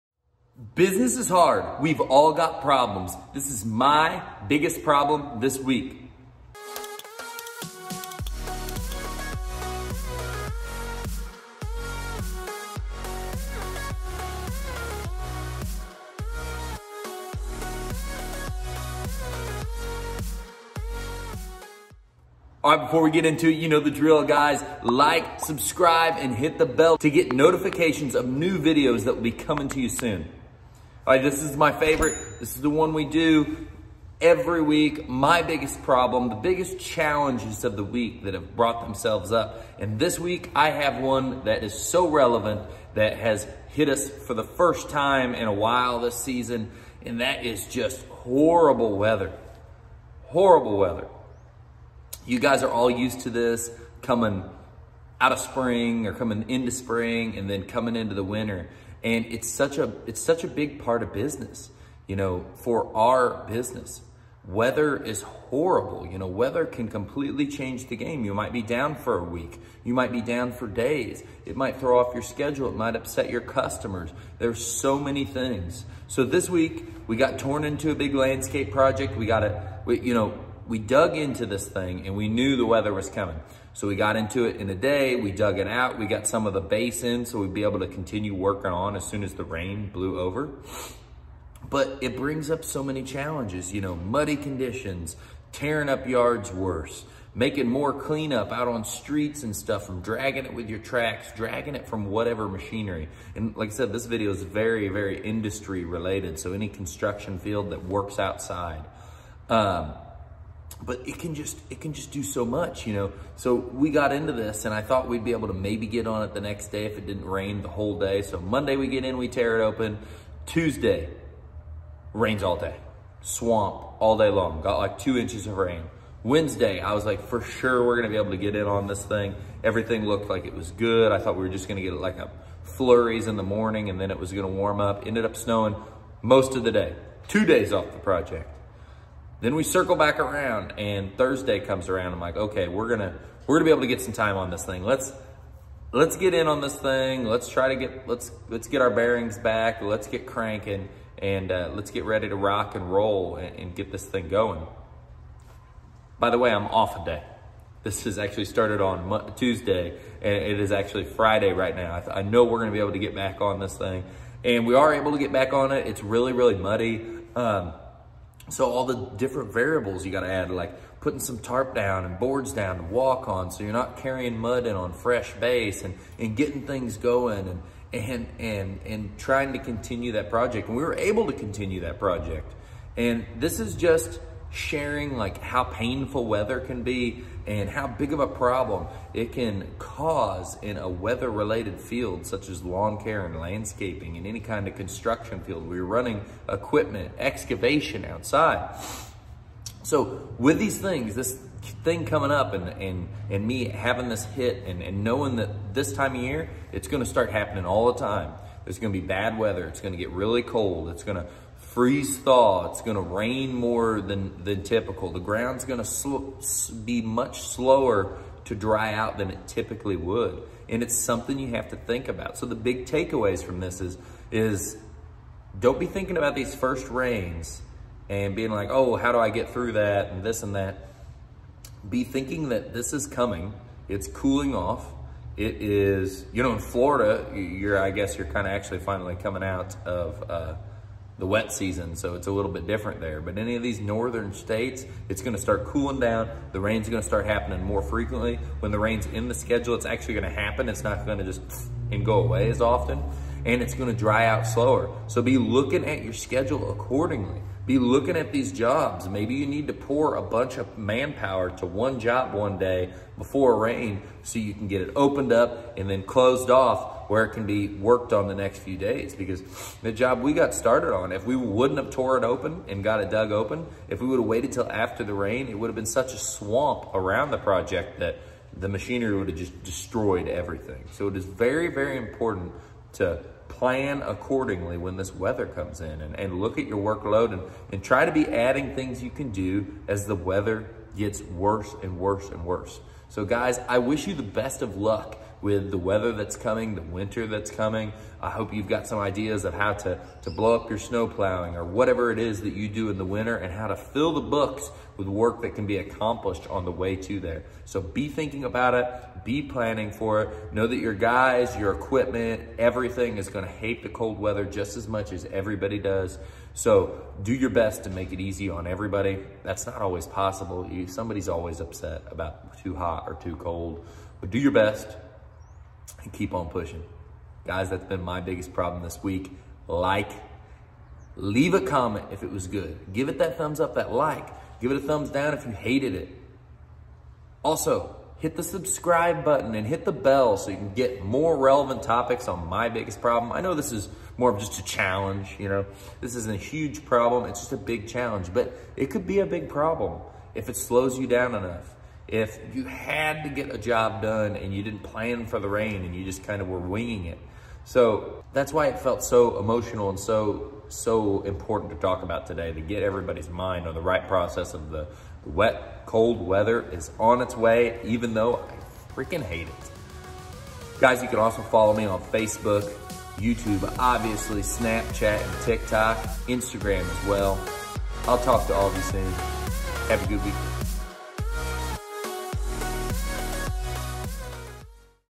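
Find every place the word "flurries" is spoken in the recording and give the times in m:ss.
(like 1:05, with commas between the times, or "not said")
2:12.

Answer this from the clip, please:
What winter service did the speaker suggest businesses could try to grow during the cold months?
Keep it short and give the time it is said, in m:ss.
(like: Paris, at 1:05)
Snow plowing, at 5:00.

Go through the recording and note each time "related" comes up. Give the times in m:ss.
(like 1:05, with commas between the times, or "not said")
1:45, 3:11.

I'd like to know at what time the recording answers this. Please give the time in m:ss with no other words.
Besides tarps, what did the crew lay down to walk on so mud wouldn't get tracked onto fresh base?
2:52.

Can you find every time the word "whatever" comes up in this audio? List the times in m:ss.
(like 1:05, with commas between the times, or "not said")
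1:42, 5:01.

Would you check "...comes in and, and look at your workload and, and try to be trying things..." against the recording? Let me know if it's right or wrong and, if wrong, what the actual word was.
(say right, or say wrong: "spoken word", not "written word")
wrong: "adding", not "trying".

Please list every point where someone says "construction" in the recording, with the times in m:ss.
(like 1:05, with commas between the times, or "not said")
1:46, 3:14.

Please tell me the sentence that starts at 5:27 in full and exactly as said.
Guys, that's been my biggest problem this week.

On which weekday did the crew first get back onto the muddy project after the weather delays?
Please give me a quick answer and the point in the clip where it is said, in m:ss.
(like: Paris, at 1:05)
Thursday, at 2:21.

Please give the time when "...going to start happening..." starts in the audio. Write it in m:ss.
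3:26.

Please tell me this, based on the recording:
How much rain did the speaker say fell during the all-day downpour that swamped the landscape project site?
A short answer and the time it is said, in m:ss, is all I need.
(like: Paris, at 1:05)
2 inches, at 2:04.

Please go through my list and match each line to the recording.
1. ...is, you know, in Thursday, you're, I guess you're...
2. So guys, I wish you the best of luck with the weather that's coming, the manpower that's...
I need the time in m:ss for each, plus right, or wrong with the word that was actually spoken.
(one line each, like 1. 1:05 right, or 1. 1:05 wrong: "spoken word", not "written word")
1. 3:55 wrong: "Florida", not "Thursday"
2. 4:53 wrong: "winter", not "manpower".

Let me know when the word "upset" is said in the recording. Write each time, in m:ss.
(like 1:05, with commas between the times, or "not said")
1:12, 5:21.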